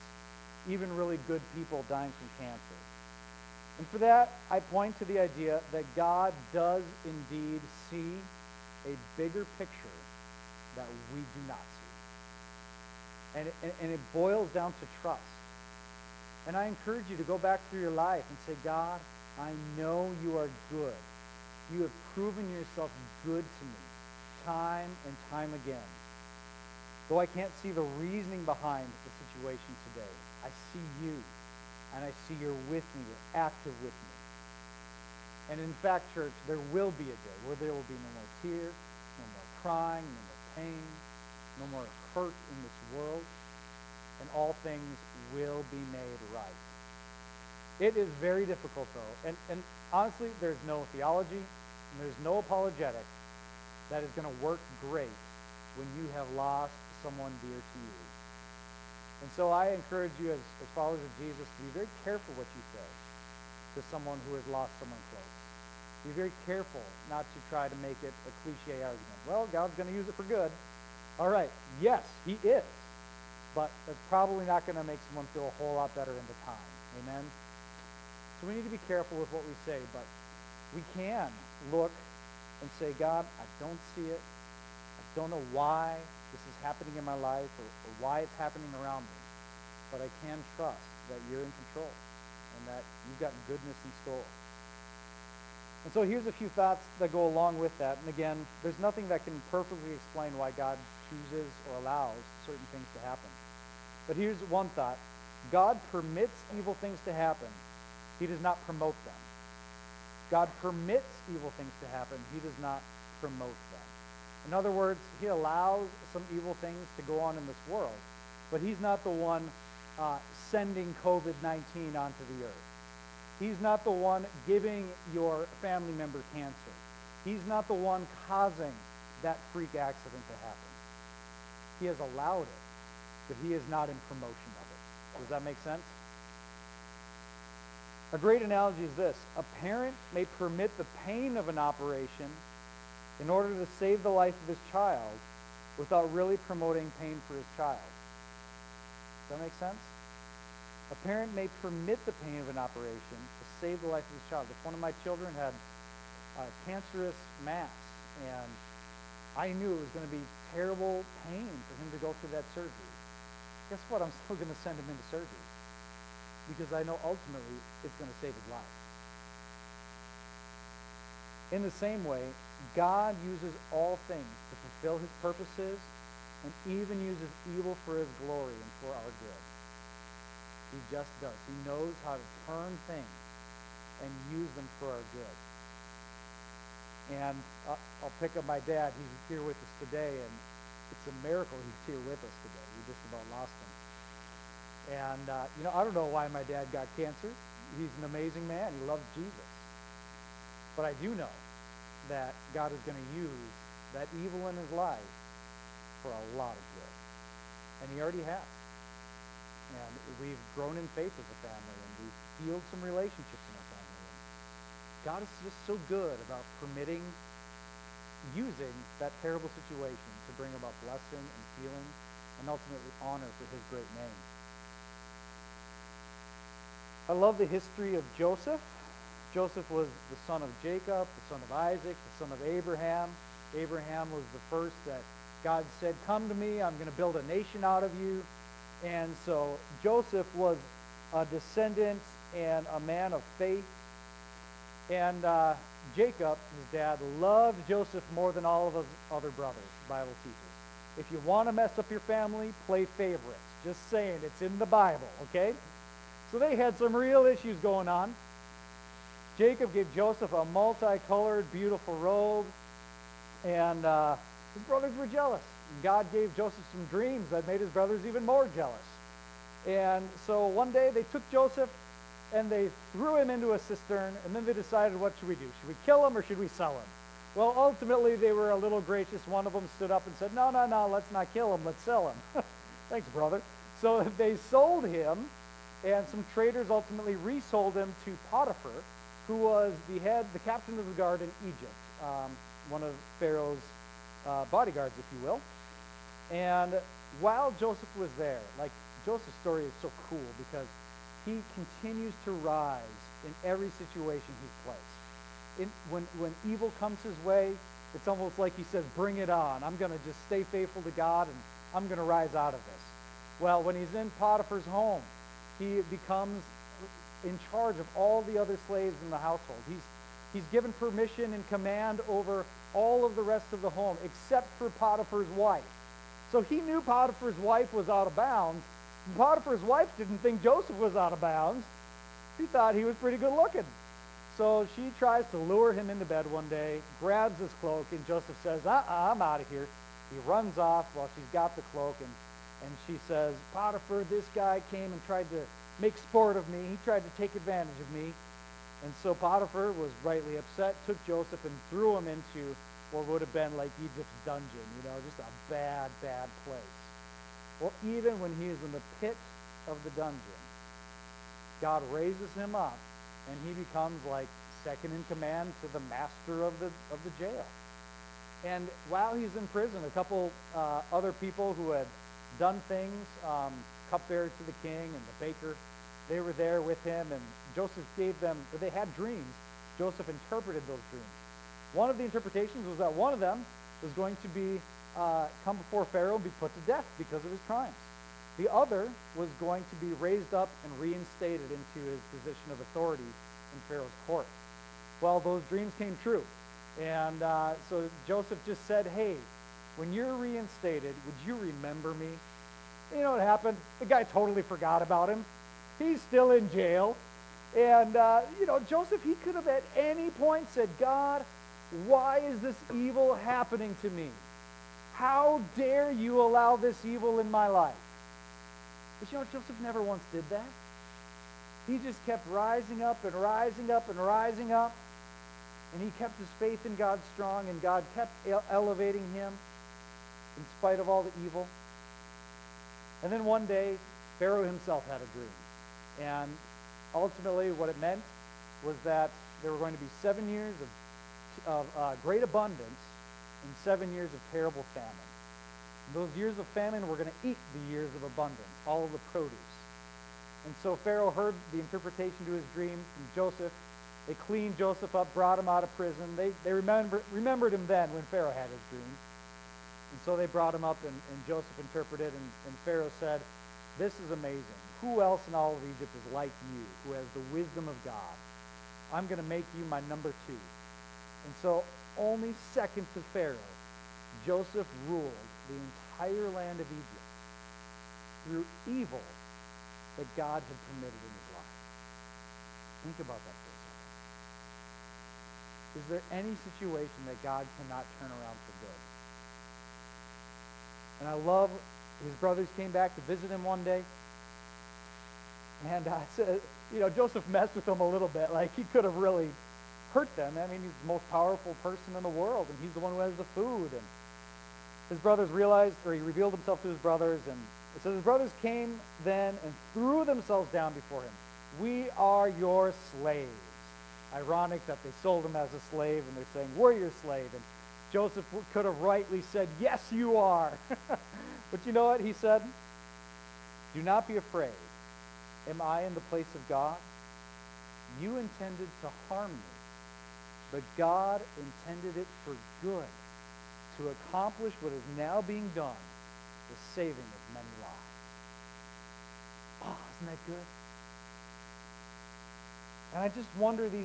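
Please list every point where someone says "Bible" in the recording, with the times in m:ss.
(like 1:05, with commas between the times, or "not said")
4:09, 4:14.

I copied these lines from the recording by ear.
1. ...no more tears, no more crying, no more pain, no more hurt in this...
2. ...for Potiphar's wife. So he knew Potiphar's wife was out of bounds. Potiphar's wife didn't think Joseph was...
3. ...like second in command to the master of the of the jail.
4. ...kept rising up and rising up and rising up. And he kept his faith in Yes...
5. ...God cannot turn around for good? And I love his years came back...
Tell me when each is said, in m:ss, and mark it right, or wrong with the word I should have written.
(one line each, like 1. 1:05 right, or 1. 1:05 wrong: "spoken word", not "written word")
1. 0:37 right
2. 5:24 right
3. 6:04 right
4. 7:02 wrong: "God", not "Yes"
5. 8:07 wrong: "brothers", not "years".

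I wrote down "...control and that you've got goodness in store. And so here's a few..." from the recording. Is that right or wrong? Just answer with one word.
right.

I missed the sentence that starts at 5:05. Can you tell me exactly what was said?
In, when, when evil comes his way, it's almost like he says, bring it on.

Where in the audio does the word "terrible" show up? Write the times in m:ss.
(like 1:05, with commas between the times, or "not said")
2:40, 3:39, 7:24.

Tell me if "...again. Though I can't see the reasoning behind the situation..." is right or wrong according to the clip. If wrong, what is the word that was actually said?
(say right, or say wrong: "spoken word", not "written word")
right.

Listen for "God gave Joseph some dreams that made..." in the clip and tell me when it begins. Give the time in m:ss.
4:25.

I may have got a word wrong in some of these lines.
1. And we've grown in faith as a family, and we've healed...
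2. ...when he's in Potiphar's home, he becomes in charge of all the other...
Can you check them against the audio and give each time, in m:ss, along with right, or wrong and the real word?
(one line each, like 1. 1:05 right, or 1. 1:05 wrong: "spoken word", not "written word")
1. 3:29 right
2. 5:13 right.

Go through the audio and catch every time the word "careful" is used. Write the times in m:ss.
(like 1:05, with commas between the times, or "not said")
1:02, 1:06, 1:18.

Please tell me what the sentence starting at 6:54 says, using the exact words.
How dare you allow this evil in my life?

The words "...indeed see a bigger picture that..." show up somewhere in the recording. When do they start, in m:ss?
0:07.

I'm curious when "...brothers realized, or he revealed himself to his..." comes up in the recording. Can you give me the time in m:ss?
8:24.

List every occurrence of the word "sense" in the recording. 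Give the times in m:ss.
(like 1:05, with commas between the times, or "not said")
2:15, 2:29.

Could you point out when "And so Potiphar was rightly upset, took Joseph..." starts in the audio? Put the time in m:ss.
5:48.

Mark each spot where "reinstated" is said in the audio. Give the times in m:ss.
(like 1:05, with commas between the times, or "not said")
6:30, 6:40.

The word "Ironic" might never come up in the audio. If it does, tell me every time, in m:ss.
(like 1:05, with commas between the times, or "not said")
8:34.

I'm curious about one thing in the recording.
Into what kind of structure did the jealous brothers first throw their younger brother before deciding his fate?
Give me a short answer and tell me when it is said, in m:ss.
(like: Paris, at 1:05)
A cistern, at 4:33.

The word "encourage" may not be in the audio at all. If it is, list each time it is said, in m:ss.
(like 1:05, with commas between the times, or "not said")
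0:16, 0:59.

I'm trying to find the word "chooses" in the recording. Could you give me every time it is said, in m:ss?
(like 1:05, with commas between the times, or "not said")
1:41.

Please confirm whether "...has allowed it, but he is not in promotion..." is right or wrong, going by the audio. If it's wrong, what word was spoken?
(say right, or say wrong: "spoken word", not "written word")
right.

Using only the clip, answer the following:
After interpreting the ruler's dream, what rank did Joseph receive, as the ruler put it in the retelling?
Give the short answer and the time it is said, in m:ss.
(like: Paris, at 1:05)
Number two, at 7:49.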